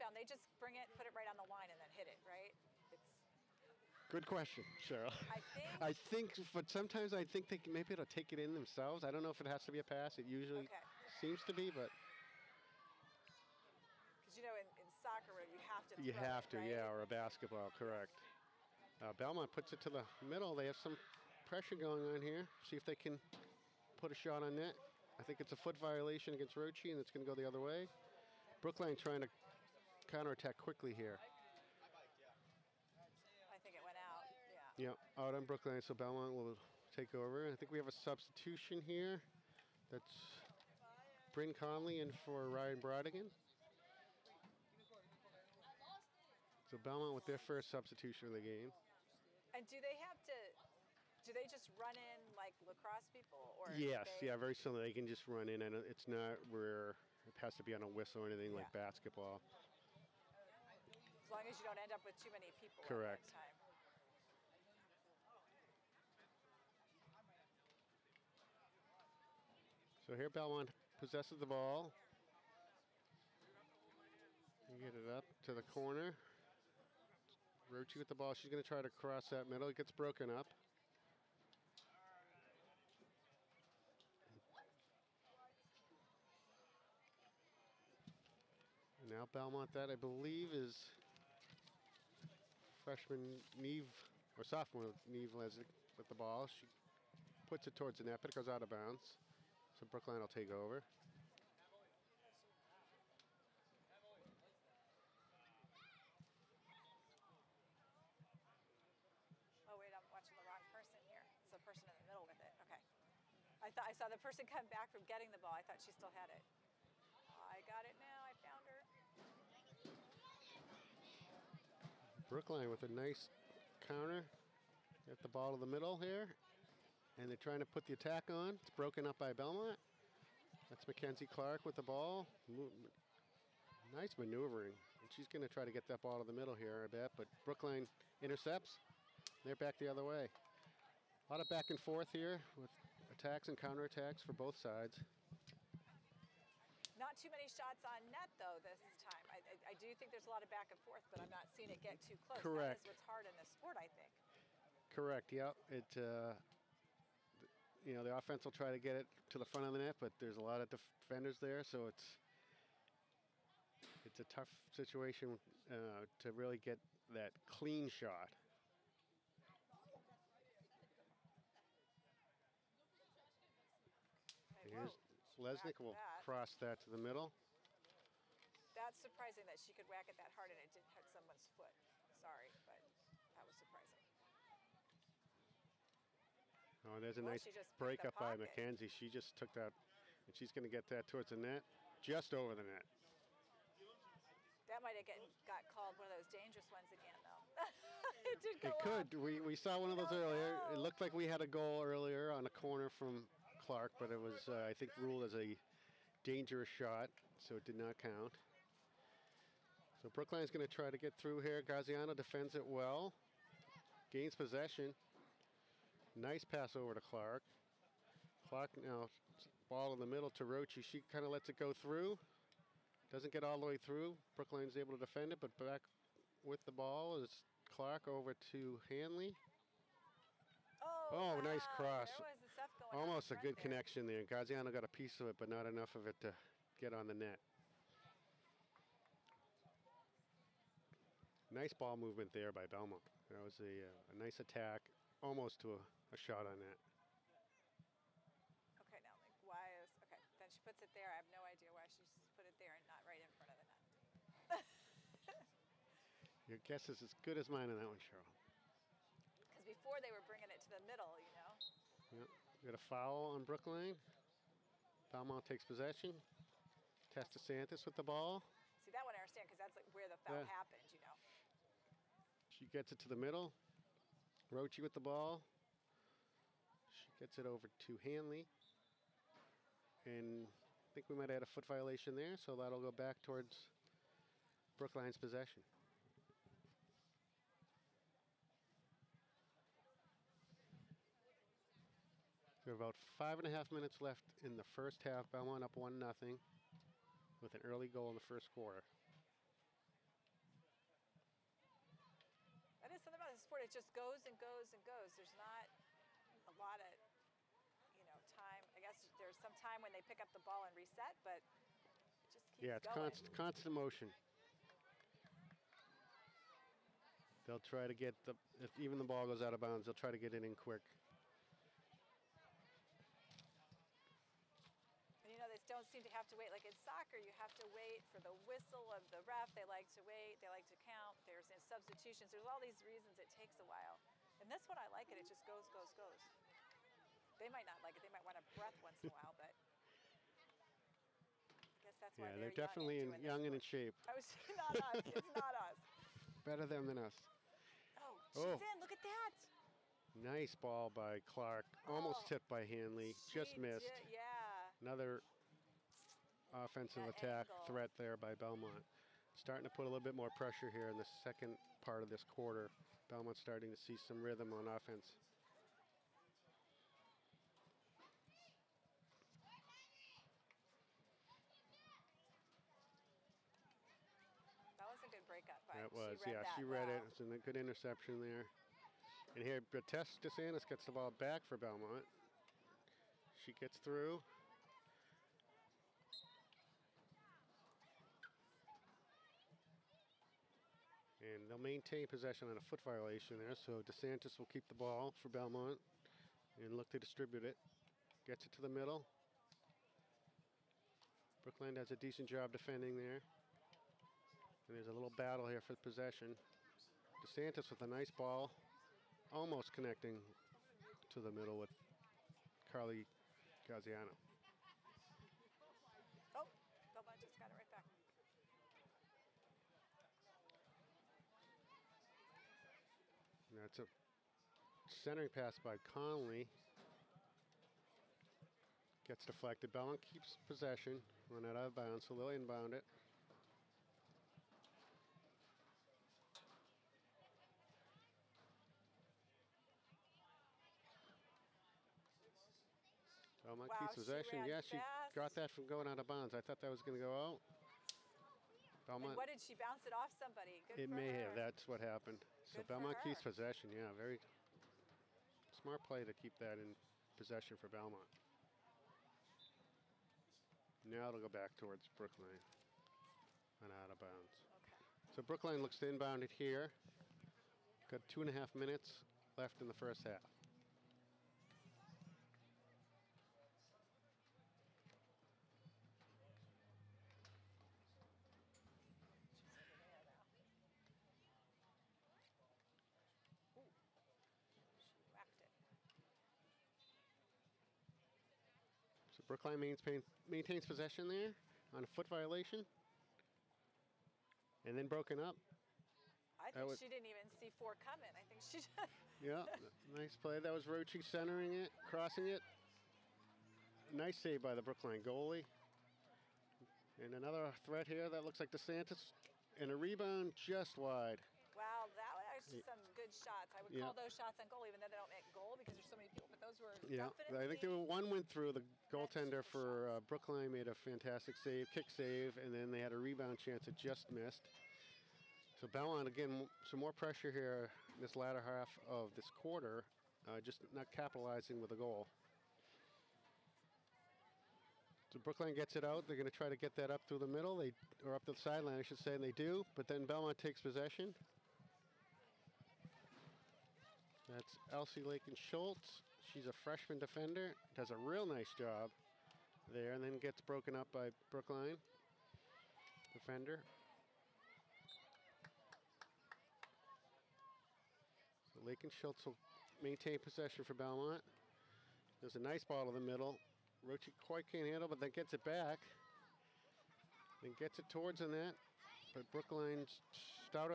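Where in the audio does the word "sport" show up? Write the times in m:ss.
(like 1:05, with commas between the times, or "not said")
2:33, 5:03.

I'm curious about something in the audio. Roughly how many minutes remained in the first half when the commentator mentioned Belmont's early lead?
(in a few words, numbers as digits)
5 and a half.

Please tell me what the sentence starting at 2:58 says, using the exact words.
That's surprising that she could whack it that hard and it didn't hit someone's foot.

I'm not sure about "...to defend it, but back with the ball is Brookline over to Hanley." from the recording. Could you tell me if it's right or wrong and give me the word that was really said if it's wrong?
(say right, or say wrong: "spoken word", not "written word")
wrong: "Clark", not "Brookline".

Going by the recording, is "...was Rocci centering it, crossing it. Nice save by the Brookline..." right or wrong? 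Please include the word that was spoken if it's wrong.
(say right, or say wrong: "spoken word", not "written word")
right.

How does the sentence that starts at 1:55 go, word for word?
I thought she still had it.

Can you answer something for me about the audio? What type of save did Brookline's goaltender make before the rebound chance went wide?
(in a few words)
kick save.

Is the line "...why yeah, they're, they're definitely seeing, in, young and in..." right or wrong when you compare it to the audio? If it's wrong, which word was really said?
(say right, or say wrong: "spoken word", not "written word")
wrong: "young", not "seeing".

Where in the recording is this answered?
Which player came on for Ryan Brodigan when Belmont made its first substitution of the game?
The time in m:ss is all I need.
0:41.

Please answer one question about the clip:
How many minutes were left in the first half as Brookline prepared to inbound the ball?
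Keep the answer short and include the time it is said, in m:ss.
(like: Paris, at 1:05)
2 and a half, at 7:48.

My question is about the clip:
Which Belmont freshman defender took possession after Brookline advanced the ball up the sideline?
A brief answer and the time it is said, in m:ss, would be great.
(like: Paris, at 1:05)
Elsie Lakin Schultz, at 9:04.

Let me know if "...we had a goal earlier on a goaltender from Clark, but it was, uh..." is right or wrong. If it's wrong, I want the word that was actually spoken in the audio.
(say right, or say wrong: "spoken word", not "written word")
wrong: "corner", not "goaltender".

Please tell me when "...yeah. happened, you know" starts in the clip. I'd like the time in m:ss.
4:30.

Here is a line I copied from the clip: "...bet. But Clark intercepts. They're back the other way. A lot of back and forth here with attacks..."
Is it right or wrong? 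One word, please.
wrong.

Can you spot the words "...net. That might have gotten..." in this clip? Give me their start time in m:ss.
3:12.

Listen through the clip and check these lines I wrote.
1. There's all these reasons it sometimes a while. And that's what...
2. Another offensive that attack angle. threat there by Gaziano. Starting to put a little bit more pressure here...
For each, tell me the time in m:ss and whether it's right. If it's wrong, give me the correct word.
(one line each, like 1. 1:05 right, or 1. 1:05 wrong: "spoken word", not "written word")
1. 5:32 wrong: "takes", not "sometimes"
2. 5:54 wrong: "Belmont", not "Gaziano".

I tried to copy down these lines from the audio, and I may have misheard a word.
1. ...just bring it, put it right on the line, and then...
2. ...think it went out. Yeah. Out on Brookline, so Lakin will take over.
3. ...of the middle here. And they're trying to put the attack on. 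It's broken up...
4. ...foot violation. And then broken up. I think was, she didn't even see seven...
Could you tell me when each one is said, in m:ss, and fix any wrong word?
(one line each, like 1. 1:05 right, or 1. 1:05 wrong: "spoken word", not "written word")
1. 0:00 right
2. 0:33 wrong: "Belmont", not "Lakin"
3. 2:05 right
4. 8:11 wrong: "four", not "seven".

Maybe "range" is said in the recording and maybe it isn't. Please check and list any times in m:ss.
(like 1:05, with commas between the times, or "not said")
not said.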